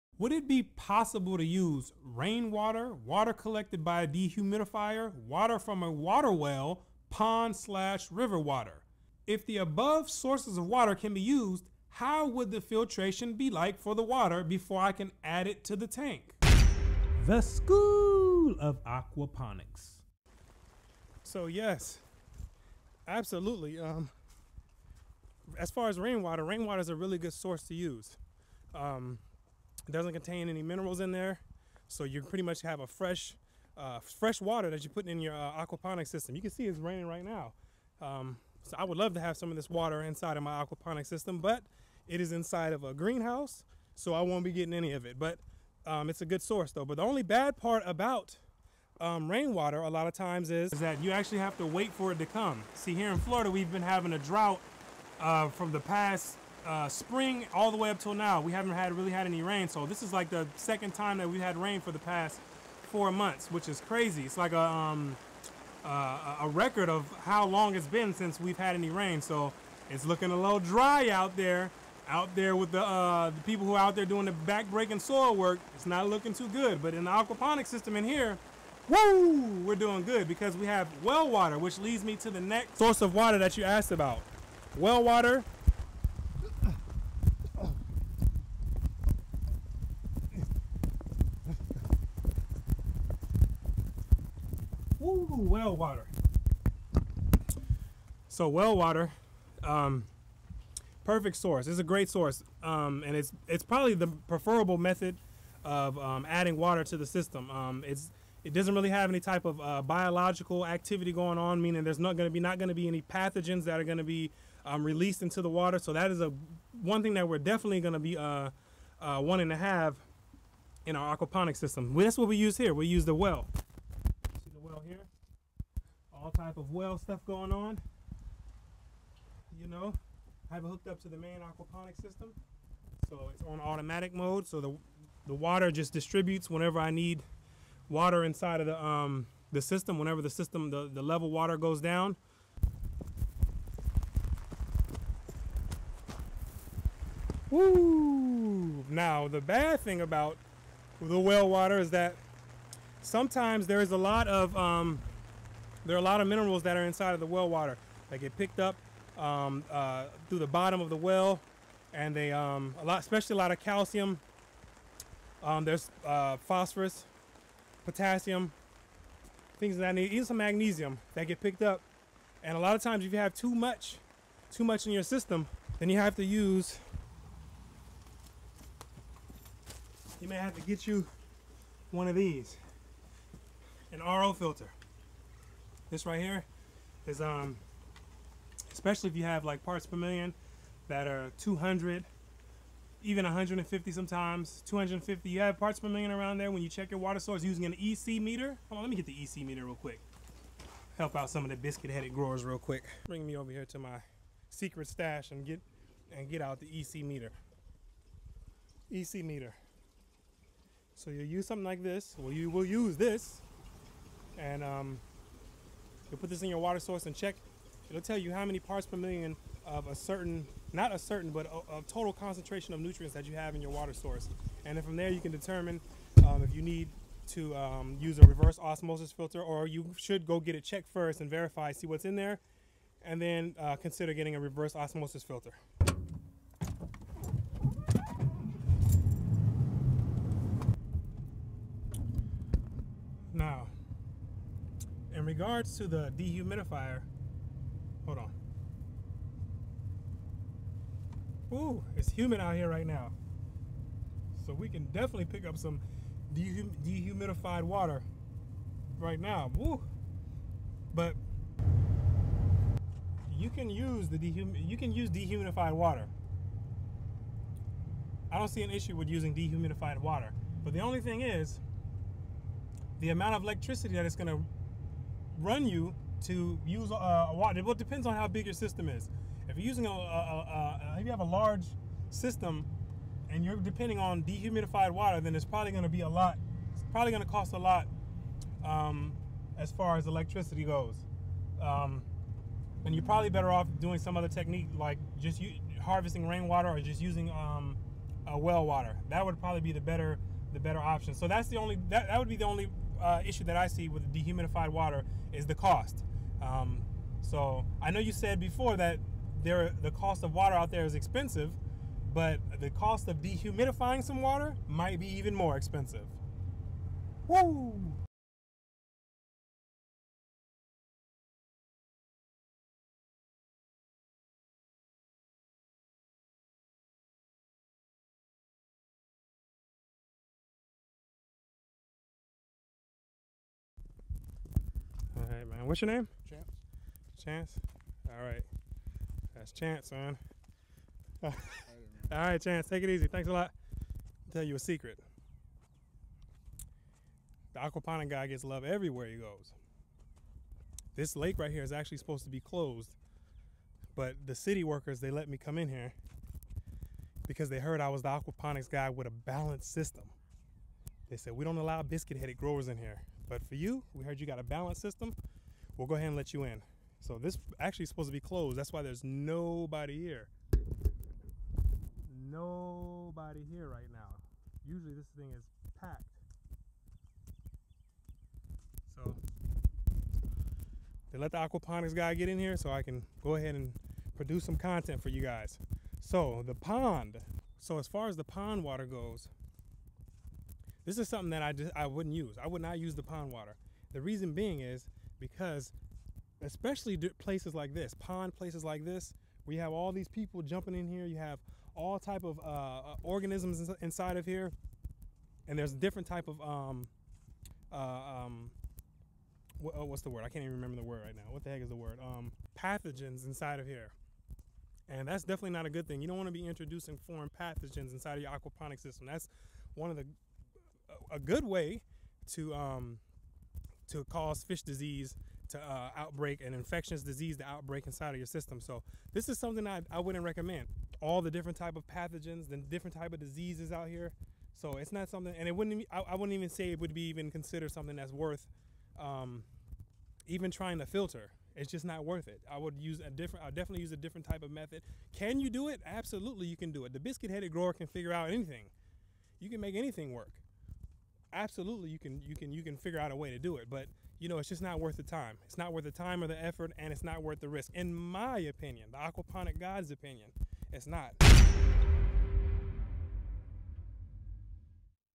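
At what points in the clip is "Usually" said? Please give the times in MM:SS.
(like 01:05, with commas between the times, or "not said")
06:14.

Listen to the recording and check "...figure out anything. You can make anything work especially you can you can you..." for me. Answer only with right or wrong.
wrong.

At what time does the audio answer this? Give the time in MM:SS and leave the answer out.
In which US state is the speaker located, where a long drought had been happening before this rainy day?
00:53.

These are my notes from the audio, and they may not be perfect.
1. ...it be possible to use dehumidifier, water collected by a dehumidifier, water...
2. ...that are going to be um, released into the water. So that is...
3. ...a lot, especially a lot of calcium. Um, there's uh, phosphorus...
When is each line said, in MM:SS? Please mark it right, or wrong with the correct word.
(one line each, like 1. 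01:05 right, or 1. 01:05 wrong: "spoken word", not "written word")
1. 00:00 wrong: "rainwater", not "dehumidifier"
2. 01:53 right
3. 02:42 right.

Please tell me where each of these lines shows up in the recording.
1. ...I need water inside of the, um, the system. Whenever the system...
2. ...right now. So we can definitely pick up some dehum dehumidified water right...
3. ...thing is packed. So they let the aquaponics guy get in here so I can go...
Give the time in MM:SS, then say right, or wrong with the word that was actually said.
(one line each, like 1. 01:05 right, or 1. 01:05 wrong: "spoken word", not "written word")
1. 02:16 right
2. 04:12 right
3. 06:15 right.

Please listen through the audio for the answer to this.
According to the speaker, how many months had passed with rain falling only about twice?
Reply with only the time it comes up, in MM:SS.
01:02.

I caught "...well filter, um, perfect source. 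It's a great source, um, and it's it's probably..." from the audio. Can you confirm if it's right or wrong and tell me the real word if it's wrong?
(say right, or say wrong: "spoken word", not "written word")
wrong: "water", not "filter".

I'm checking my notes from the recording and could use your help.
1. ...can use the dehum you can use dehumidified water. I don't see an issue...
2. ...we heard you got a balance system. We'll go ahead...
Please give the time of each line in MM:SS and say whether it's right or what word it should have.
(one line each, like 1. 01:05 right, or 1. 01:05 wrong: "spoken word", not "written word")
1. 04:23 right
2. 06:03 right.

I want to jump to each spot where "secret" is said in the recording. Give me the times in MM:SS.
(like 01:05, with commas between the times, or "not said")
03:24, 05:44.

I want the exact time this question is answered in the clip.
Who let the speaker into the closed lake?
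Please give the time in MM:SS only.
05:54.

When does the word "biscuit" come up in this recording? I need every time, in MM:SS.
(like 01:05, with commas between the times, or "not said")
03:21, 06:01, 07:26.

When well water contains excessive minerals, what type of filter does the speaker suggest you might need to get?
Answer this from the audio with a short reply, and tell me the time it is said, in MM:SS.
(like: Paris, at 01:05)
RO filter, at 03:03.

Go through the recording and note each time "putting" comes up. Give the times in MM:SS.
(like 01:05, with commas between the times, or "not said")
00:34.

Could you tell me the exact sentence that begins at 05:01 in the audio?
So that's the only that, that would be the only uh, issue that I see with dehumidified water is the cost.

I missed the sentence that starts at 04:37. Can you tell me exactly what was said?
Well, it depends on how big your system is.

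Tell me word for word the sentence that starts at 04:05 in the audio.
in regards to the dehumidifier, hold on.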